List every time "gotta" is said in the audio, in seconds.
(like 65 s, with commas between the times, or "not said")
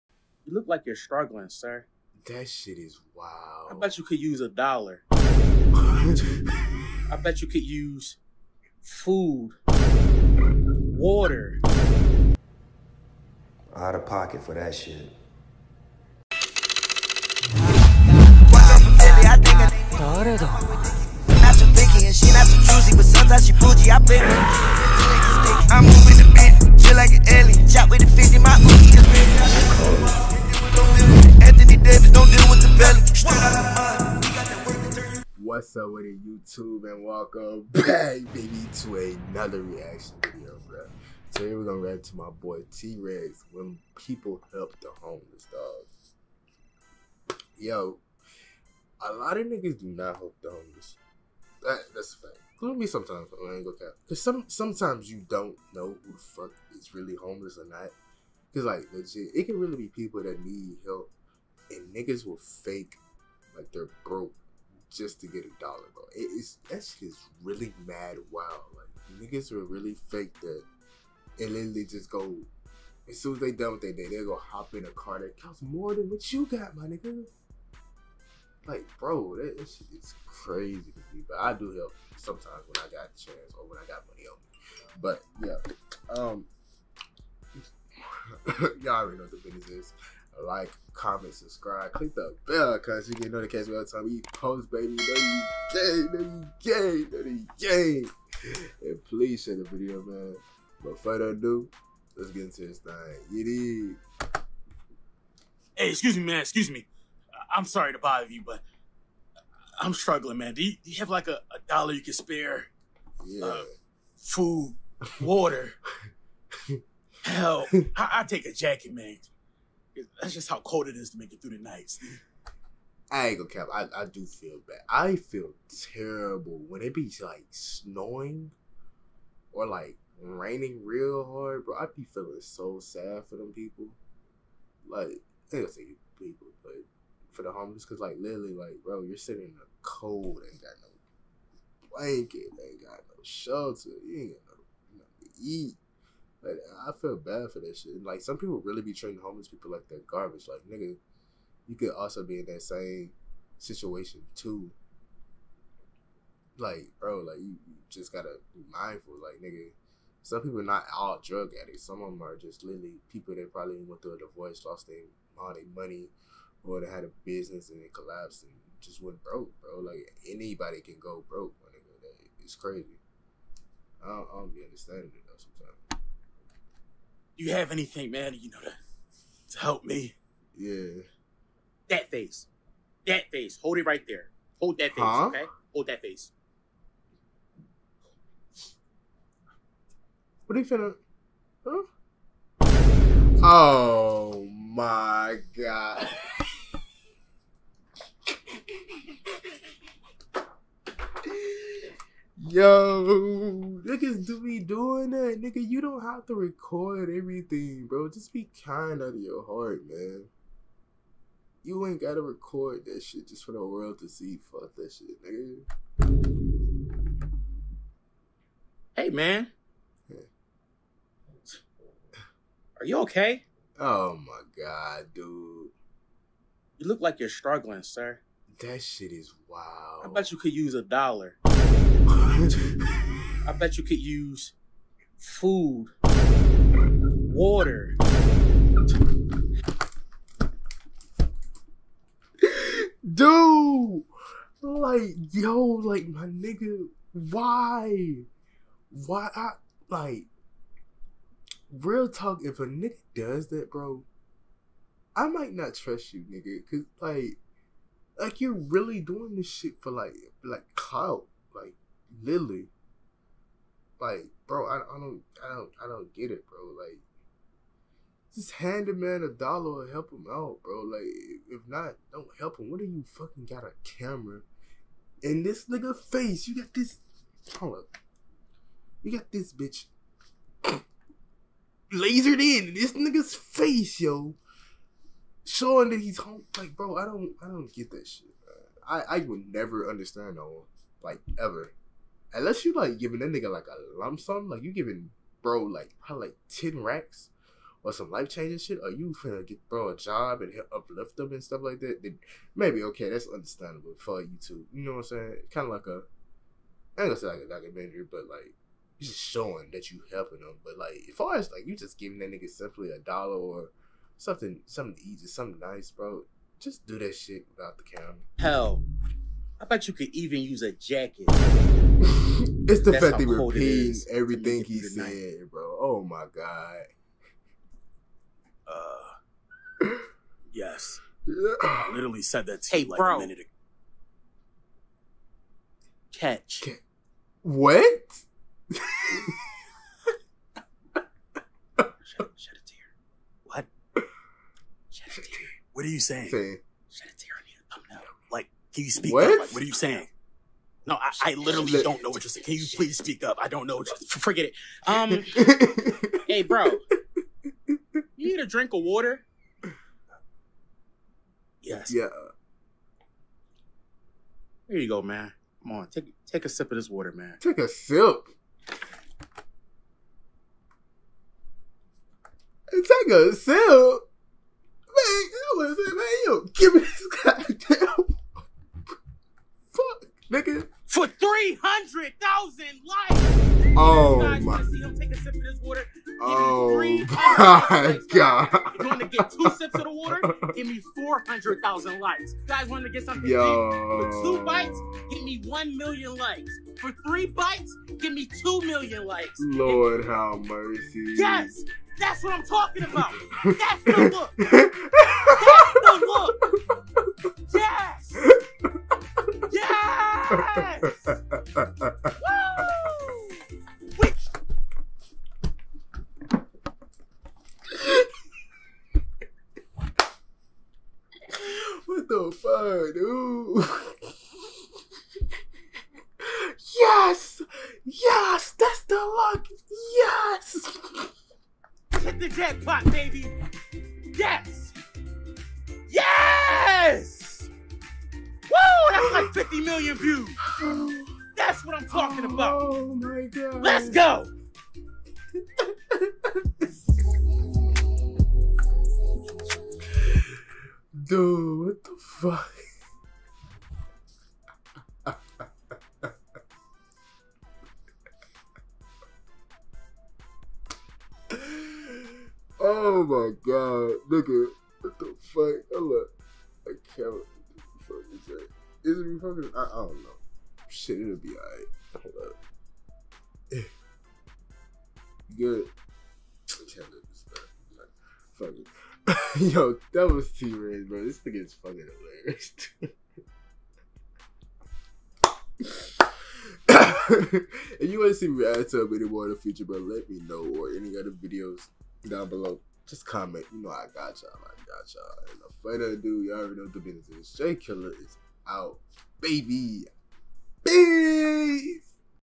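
158 s, 212 s.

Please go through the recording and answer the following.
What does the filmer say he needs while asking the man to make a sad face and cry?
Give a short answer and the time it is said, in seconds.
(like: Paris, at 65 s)
A thumbnail, at 347 s.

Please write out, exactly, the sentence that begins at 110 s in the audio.
Do you, do you have like a, a, dollar you can spare?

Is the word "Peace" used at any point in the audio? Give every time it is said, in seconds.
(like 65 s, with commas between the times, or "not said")
500 s.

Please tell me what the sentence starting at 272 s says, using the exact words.
What do you fucking got a camera in this nigga face?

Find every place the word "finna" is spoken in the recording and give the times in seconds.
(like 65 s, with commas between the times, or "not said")
190 s, 299 s.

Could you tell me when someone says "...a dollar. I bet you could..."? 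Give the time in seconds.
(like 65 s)
4 s.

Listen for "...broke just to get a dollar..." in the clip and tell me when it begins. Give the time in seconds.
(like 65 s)
64 s.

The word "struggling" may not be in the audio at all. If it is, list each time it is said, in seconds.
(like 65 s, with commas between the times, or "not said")
0 s, 109 s, 227 s.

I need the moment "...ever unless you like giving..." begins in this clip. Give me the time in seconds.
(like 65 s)
291 s.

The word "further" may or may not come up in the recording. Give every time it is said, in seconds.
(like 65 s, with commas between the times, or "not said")
100 s, 495 s.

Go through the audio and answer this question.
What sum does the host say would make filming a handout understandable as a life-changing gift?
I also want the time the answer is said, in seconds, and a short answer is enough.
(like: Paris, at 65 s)
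Ten racks, at 296 s.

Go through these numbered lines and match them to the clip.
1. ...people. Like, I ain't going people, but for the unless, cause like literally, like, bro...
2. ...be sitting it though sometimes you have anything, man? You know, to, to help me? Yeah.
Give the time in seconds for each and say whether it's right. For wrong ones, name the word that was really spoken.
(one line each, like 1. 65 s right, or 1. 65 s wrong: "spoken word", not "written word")
1. 133 s wrong: "homeless", not "unless"
2. 174 s wrong: "understanding", not "sitting".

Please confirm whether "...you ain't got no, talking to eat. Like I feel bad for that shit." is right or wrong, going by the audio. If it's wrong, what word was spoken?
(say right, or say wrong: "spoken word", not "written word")
wrong: "nothing", not "talking".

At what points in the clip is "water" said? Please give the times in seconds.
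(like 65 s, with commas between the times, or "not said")
10 s, 115 s, 237 s, 358 s, 366 s, 385 s, 389 s.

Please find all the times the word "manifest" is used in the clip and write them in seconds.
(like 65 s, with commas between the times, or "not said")
not said.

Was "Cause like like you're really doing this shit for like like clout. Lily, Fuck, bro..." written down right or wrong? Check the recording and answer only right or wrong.
wrong.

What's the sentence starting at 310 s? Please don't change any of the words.
But like as far as like you just giving that nigga simply a dollar or something, something easy, something nice, bro.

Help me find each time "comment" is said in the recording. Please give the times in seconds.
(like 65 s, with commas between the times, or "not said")
90 s, 493 s.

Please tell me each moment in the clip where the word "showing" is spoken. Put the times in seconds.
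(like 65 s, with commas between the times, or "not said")
285 s, 309 s.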